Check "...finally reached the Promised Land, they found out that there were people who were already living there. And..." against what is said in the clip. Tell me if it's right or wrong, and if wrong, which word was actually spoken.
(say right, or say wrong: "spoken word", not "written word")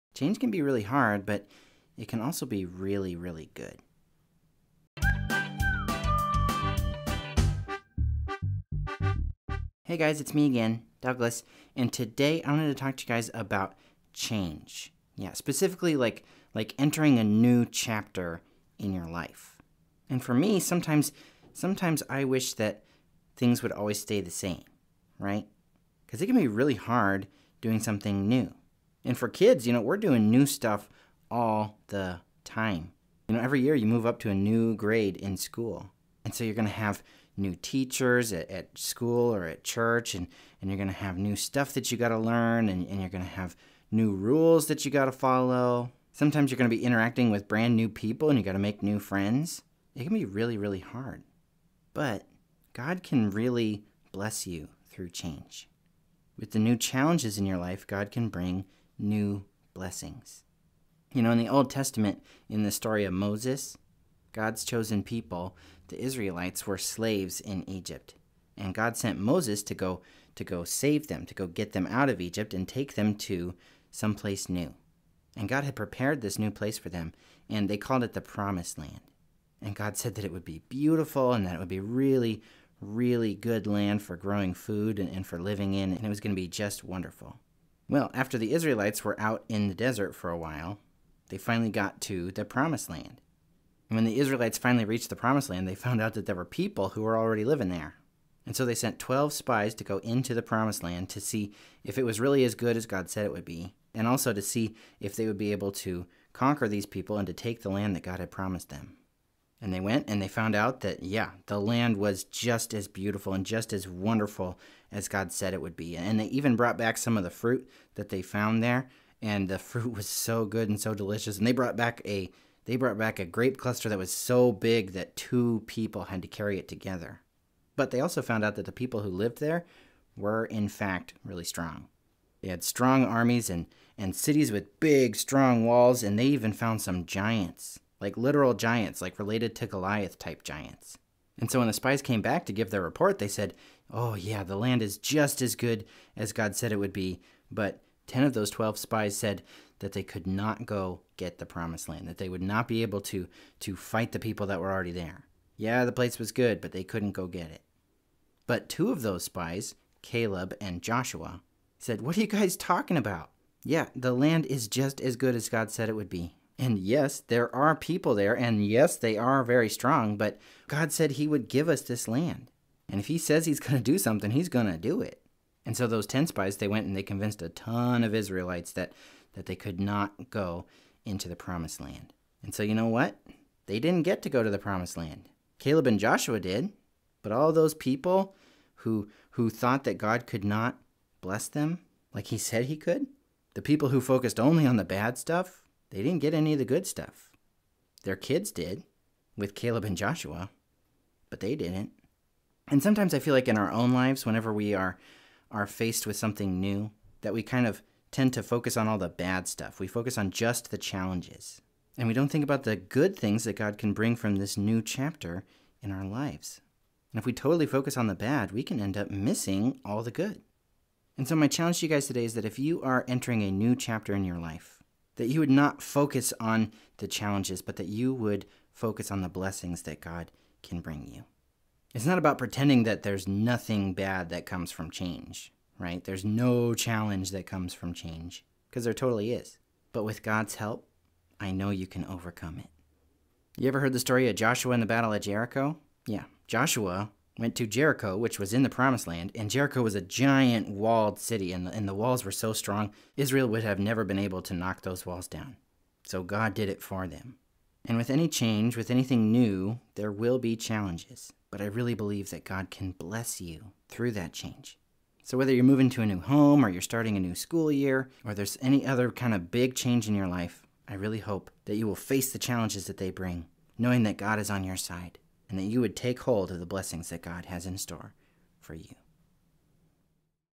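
right.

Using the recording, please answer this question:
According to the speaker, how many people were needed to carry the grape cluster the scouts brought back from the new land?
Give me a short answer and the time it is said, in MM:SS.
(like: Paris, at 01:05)
2, at 02:05.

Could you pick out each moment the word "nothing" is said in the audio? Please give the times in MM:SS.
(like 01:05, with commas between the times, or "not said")
03:53.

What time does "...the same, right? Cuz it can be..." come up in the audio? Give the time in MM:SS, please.
00:24.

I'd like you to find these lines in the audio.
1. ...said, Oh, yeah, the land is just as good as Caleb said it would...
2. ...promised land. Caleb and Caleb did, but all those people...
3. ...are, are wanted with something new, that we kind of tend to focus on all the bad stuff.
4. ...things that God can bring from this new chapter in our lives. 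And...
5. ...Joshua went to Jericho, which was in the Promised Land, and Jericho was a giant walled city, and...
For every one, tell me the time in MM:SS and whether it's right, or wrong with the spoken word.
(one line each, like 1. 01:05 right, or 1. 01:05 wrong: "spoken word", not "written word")
1. 02:23 wrong: "God", not "Caleb"
2. 03:04 wrong: "Joshua", not "Caleb"
3. 03:24 wrong: "faced", not "wanted"
4. 03:33 right
5. 04:06 right.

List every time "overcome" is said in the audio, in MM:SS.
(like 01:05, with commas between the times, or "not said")
04:02.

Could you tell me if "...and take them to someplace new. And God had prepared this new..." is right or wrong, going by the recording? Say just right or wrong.
right.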